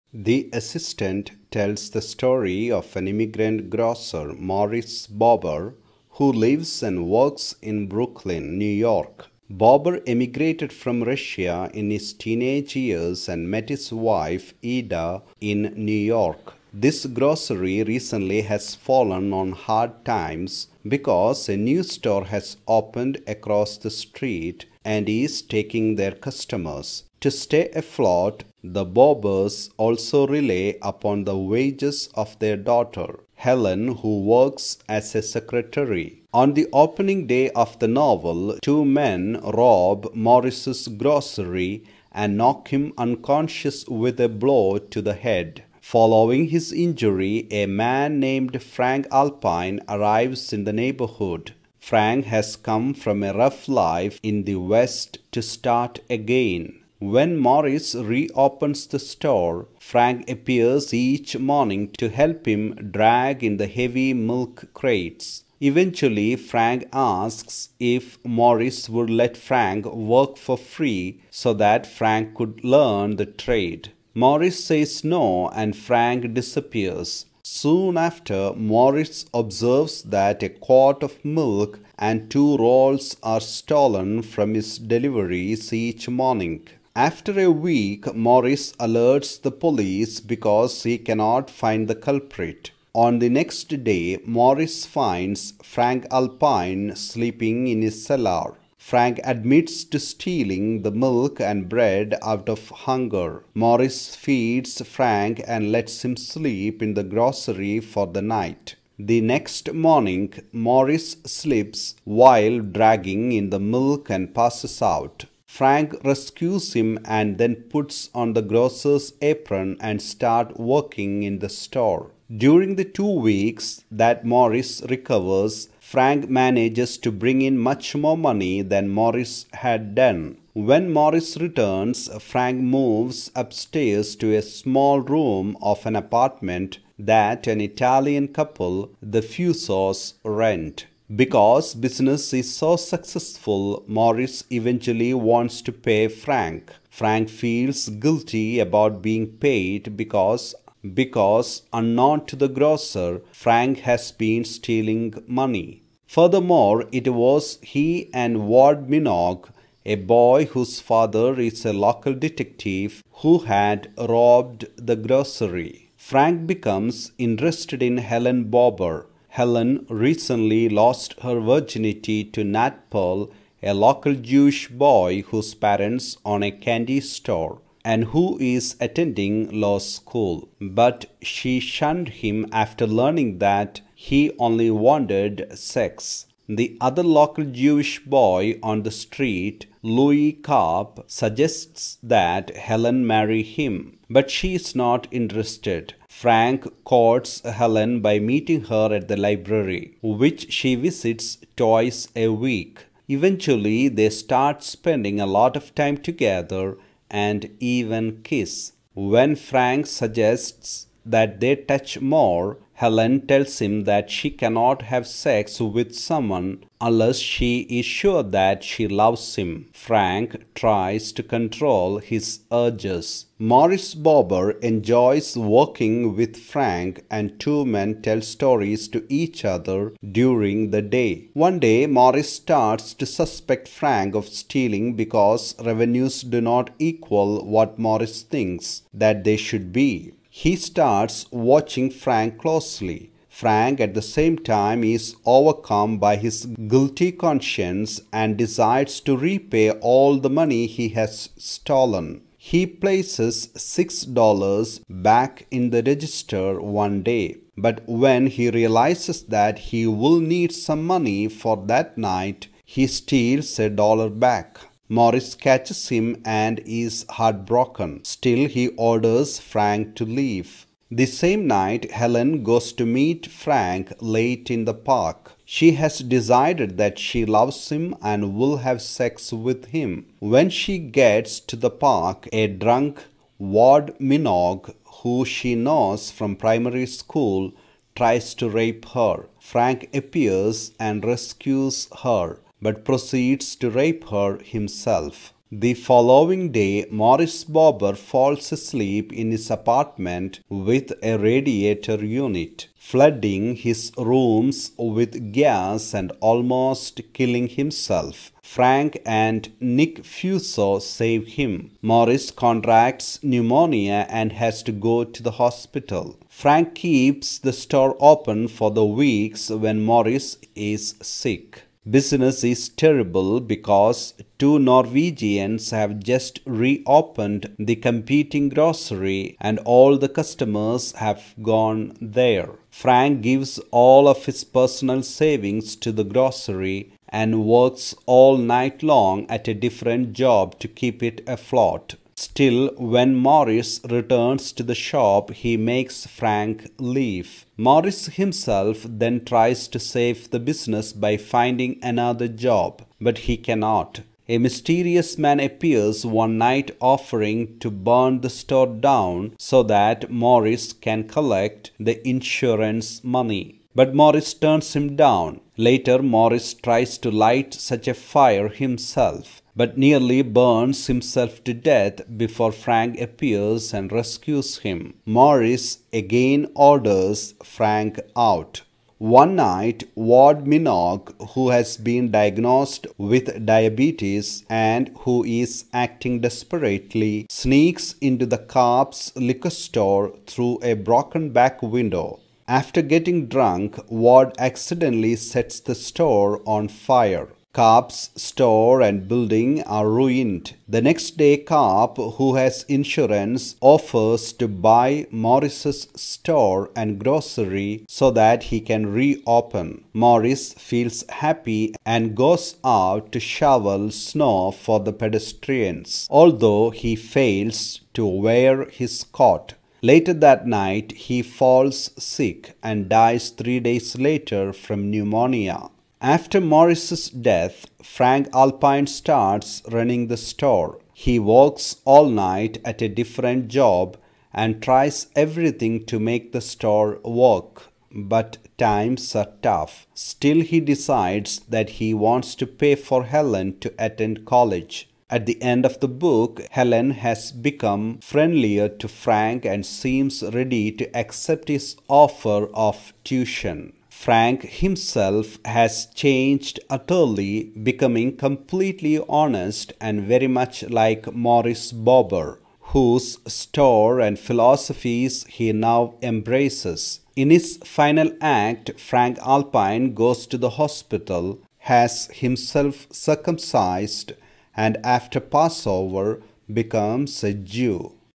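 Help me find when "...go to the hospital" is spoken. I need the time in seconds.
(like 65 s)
314 s.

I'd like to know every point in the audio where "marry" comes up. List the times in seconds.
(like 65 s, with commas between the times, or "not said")
193 s.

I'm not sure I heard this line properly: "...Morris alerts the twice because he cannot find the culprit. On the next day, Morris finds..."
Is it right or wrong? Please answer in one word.
wrong.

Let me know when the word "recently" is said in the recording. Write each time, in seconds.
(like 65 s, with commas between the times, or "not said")
17 s, 169 s.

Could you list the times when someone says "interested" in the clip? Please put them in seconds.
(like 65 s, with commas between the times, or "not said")
167 s, 195 s.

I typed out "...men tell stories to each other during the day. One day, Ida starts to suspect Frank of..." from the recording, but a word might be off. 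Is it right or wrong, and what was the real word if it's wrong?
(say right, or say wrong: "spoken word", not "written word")
wrong: "Morris", not "Ida".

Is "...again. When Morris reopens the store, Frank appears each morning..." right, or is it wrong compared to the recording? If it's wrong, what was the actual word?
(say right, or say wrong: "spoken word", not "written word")
right.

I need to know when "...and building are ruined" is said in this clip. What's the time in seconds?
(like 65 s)
398 s.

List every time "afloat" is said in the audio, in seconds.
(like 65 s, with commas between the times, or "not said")
27 s, 341 s.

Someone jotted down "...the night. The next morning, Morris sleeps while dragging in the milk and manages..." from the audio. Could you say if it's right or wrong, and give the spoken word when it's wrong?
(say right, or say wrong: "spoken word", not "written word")
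wrong: "passes", not "manages".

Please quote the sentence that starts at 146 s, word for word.
Frank feels guilty about being paid because because unknown to the grocer, Frank has been stealing money.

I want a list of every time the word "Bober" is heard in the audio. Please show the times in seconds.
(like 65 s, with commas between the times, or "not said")
5 s, 9 s, 28 s, 168 s, 223 s, 297 s, 461 s.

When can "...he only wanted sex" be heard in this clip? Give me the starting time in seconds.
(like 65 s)
183 s.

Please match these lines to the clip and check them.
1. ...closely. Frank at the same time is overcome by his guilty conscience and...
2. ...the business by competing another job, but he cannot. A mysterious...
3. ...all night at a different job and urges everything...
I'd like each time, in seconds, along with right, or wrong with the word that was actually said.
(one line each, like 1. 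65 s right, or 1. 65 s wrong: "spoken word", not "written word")
1. 242 s right
2. 350 s wrong: "finding", not "competing"
3. 431 s wrong: "tries", not "urges".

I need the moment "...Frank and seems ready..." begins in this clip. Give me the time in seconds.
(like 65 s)
448 s.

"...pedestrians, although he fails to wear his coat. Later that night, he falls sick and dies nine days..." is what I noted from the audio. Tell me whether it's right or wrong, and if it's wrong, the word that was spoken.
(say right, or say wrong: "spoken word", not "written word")
wrong: "three", not "nine".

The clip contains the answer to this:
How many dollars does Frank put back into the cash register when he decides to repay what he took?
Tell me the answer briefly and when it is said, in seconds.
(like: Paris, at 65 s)
6, at 253 s.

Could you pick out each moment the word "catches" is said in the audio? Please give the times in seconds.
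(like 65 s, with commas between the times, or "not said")
265 s.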